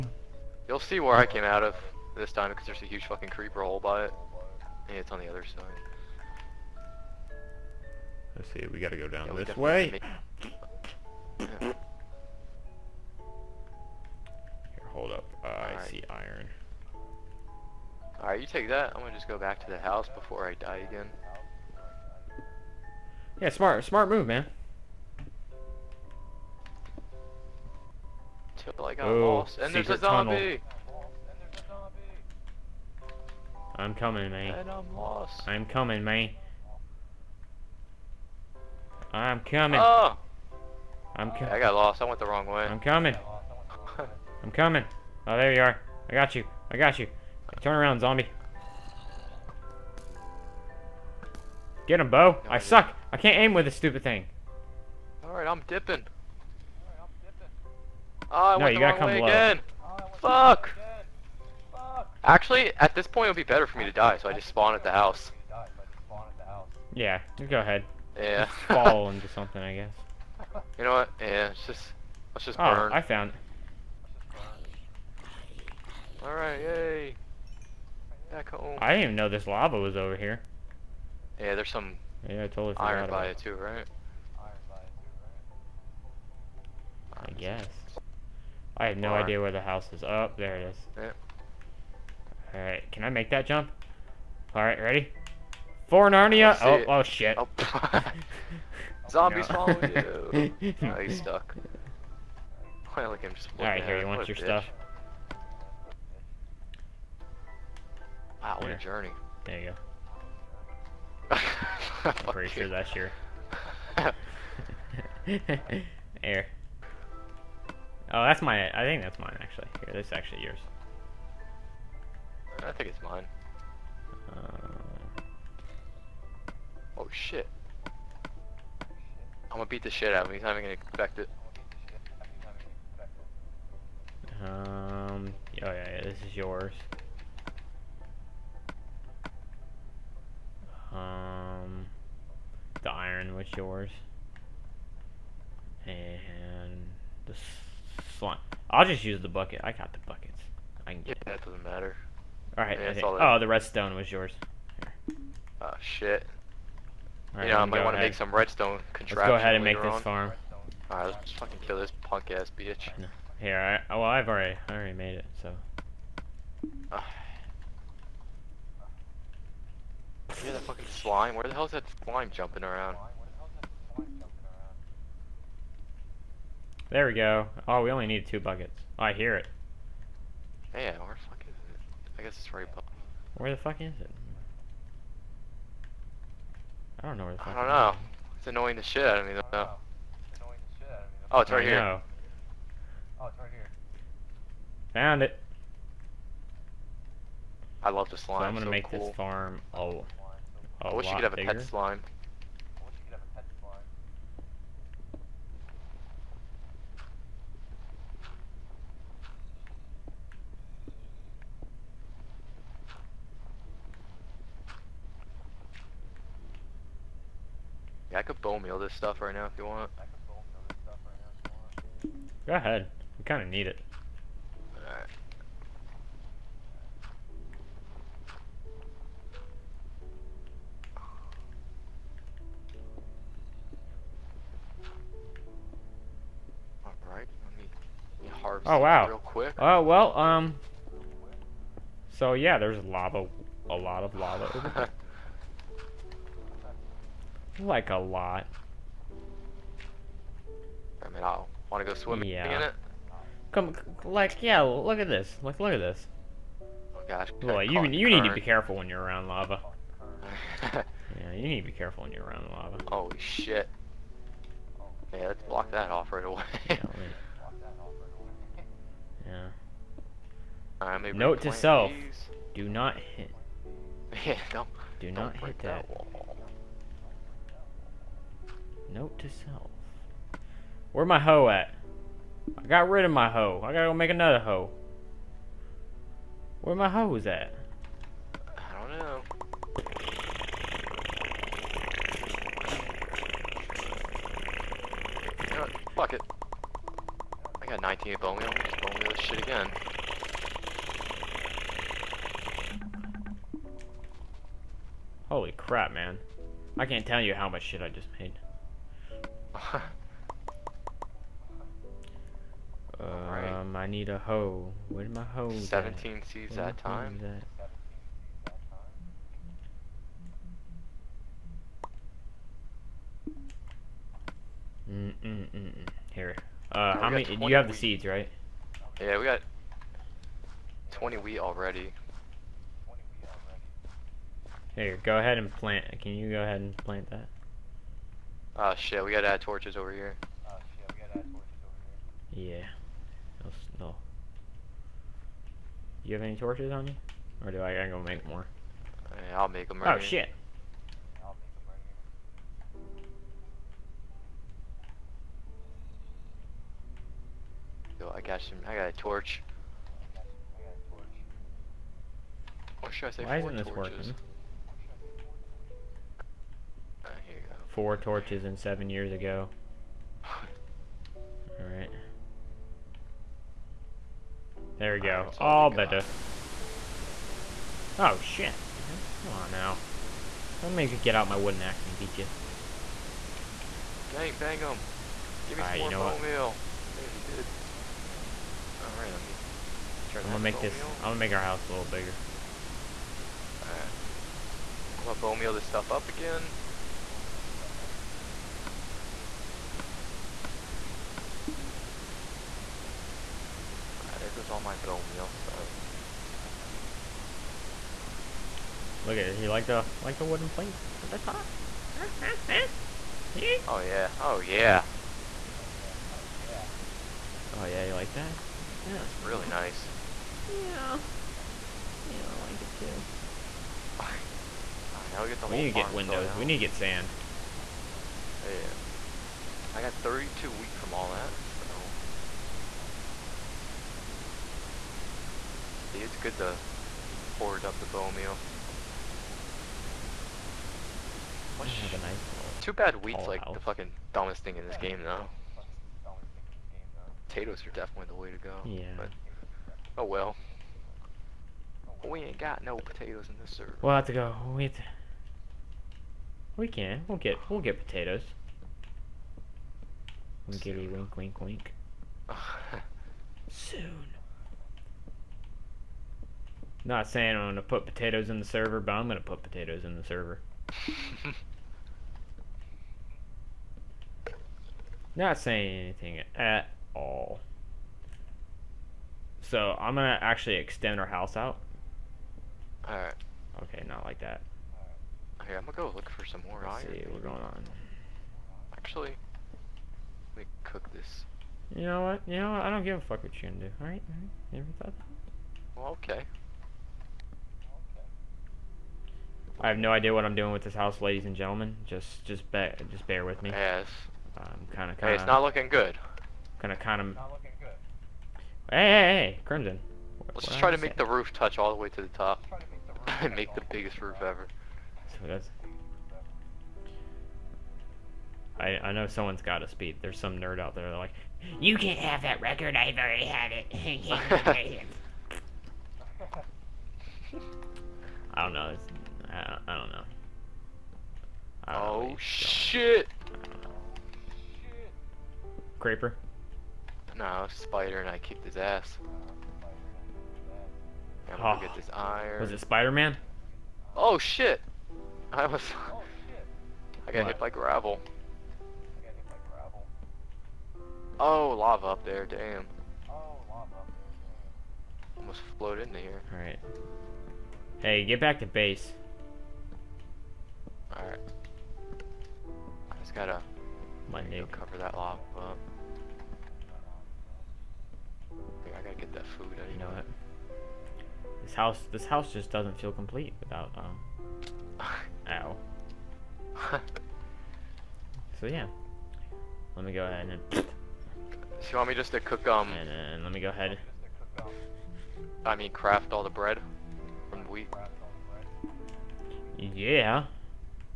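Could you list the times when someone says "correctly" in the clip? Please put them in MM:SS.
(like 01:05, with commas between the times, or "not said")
not said.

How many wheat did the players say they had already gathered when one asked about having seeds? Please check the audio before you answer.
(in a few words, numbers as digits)
20.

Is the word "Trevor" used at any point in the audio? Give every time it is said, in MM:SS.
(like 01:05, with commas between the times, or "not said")
not said.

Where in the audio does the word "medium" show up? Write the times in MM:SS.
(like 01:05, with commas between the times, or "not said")
not said.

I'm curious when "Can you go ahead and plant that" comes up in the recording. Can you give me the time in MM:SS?
05:36.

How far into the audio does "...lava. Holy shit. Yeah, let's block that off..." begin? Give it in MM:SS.
04:22.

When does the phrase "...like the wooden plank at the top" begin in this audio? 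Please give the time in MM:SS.
06:50.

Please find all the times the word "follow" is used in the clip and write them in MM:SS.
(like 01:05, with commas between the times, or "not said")
01:39.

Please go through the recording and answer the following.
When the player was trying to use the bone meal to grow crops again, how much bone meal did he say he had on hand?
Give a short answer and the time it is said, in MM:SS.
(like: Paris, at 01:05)
98, at 04:57.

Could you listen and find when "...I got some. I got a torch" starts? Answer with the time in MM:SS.
05:58.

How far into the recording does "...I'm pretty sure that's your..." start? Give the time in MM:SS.
01:52.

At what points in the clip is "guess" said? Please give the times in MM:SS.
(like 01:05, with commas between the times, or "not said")
01:09, 01:27, 03:02.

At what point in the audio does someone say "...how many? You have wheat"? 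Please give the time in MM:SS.
05:27.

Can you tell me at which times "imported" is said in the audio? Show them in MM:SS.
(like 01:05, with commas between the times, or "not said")
not said.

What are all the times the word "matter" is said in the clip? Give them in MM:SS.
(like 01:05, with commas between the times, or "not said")
02:31.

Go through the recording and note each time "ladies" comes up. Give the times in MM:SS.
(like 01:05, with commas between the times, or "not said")
08:21.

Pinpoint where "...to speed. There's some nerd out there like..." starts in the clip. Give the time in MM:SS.
08:39.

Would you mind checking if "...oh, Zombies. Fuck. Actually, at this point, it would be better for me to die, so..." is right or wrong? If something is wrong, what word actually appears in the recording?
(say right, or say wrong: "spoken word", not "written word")
wrong: "Again", not "Zombies".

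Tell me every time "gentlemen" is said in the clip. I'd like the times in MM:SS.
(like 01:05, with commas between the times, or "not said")
08:21.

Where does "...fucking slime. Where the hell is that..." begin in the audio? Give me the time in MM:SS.
02:50.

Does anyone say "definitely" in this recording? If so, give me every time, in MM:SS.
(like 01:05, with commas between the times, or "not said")
07:27.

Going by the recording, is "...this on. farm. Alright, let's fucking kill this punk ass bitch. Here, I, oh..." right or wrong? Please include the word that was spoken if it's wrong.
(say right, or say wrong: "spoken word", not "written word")
right.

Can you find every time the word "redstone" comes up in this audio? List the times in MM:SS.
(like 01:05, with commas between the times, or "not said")
02:33, 02:38.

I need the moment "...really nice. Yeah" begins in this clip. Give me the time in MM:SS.
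06:59.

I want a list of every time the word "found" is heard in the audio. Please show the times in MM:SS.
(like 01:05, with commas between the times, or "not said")
01:13, 03:14.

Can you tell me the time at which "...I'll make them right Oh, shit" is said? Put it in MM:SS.
05:49.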